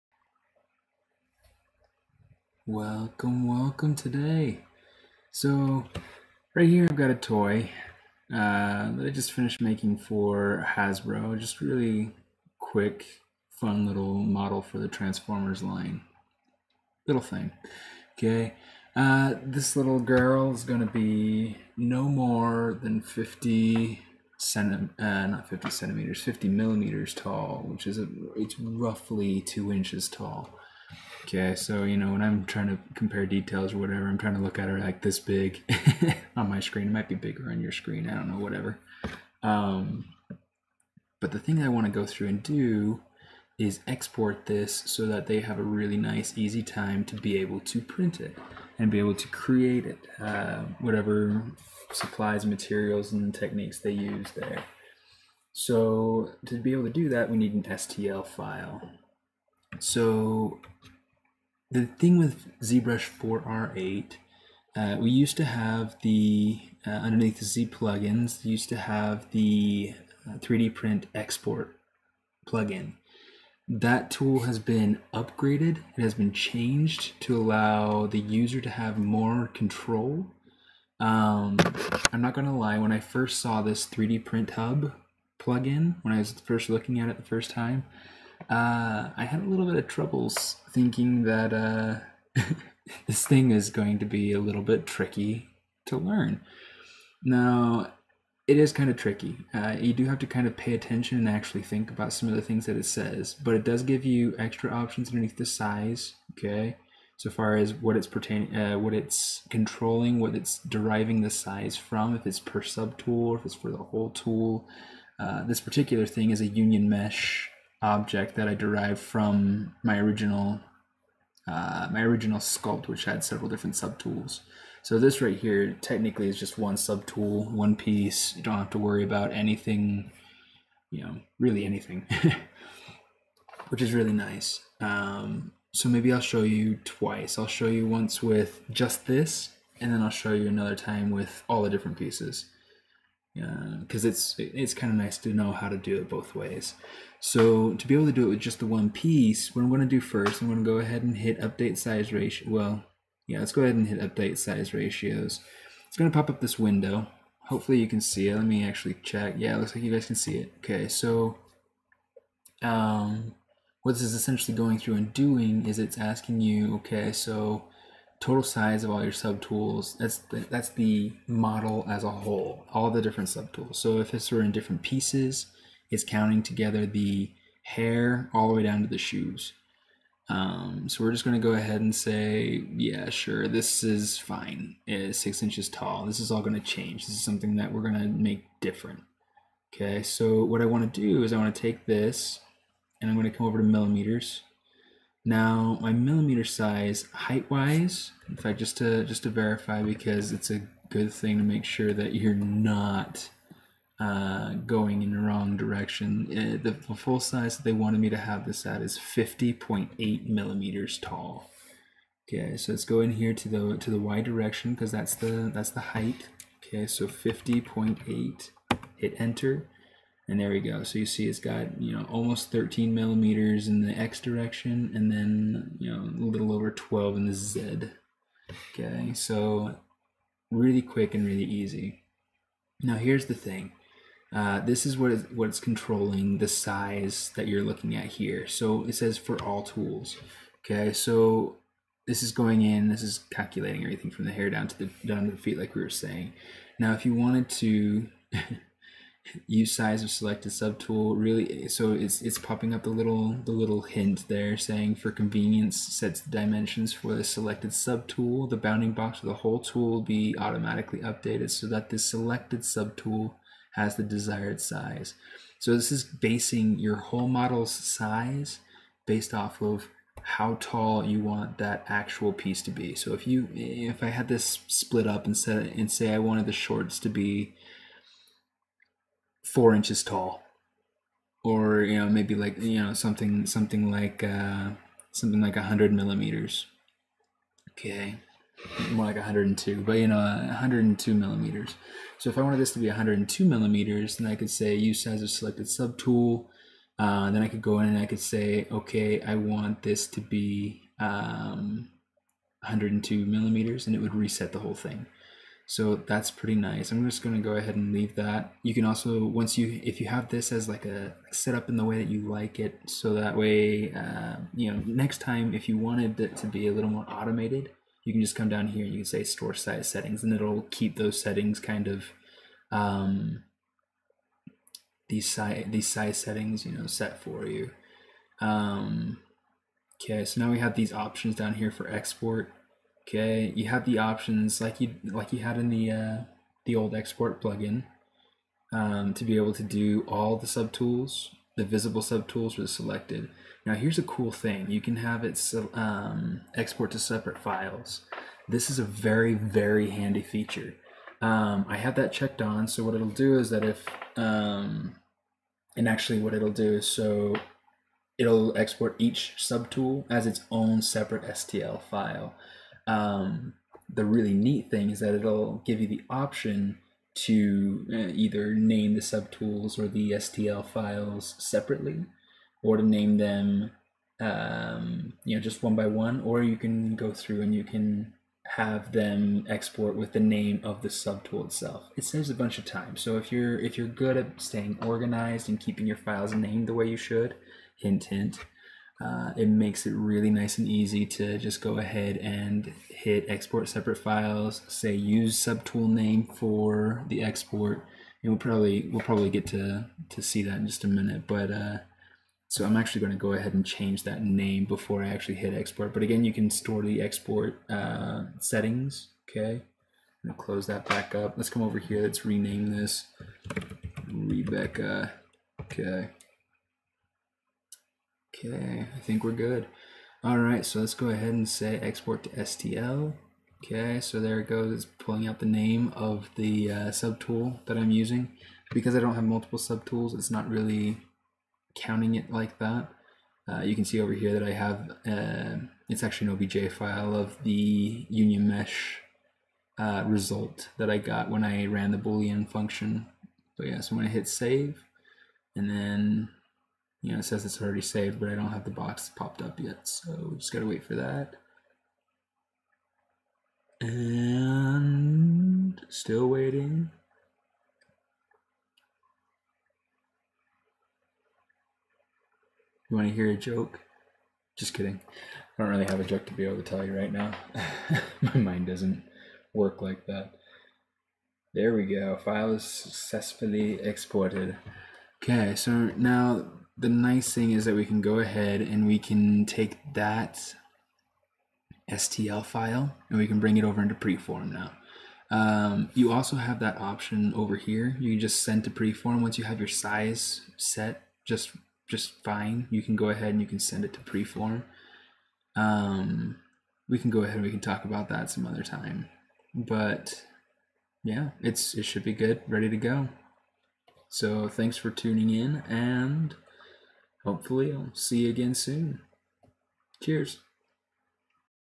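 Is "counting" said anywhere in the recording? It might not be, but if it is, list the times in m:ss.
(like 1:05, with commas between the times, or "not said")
2:56, 7:11.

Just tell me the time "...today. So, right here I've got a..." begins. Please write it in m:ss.
0:03.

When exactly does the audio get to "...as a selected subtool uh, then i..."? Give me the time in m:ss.
4:55.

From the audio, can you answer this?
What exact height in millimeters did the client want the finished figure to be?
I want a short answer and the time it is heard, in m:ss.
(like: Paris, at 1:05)
50.8 millimeters, at 3:28.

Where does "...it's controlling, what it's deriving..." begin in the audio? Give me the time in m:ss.
1:48.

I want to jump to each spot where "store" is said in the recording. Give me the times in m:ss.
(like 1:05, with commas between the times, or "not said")
5:19, 6:46.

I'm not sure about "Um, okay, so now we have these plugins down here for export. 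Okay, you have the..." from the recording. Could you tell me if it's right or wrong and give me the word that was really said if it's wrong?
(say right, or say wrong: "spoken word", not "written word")
wrong: "options", not "plugins".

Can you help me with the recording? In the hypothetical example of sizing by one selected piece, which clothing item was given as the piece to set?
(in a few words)
the shorts.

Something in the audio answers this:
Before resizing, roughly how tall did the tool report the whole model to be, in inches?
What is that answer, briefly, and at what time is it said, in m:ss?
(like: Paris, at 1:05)
6 inches, at 3:05.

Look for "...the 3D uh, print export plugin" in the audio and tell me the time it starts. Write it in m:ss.
1:09.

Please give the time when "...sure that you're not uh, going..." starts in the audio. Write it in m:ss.
3:21.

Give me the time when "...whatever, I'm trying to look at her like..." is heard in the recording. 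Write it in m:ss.
0:33.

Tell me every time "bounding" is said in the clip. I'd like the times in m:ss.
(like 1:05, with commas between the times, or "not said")
4:18.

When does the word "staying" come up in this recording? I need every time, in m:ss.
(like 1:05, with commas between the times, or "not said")
6:24.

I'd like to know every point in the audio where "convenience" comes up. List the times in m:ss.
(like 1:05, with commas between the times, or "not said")
4:15.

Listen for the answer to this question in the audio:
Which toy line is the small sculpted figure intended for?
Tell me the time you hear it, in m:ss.
0:14.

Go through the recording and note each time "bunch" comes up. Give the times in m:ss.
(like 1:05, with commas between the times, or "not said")
6:22.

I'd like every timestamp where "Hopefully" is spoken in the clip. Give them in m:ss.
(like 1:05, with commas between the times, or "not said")
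2:37, 8:27.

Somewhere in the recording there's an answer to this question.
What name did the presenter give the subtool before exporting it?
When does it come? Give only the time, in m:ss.
6:54.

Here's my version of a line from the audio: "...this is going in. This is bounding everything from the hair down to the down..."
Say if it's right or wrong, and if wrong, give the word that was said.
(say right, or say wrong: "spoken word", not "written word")
wrong: "calculating", not "bounding".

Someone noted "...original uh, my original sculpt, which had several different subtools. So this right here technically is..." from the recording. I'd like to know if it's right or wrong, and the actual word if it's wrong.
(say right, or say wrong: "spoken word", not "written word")
right.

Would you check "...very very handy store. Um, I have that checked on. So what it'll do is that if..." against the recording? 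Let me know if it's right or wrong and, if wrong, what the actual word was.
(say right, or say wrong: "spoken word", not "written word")
wrong: "feature", not "store".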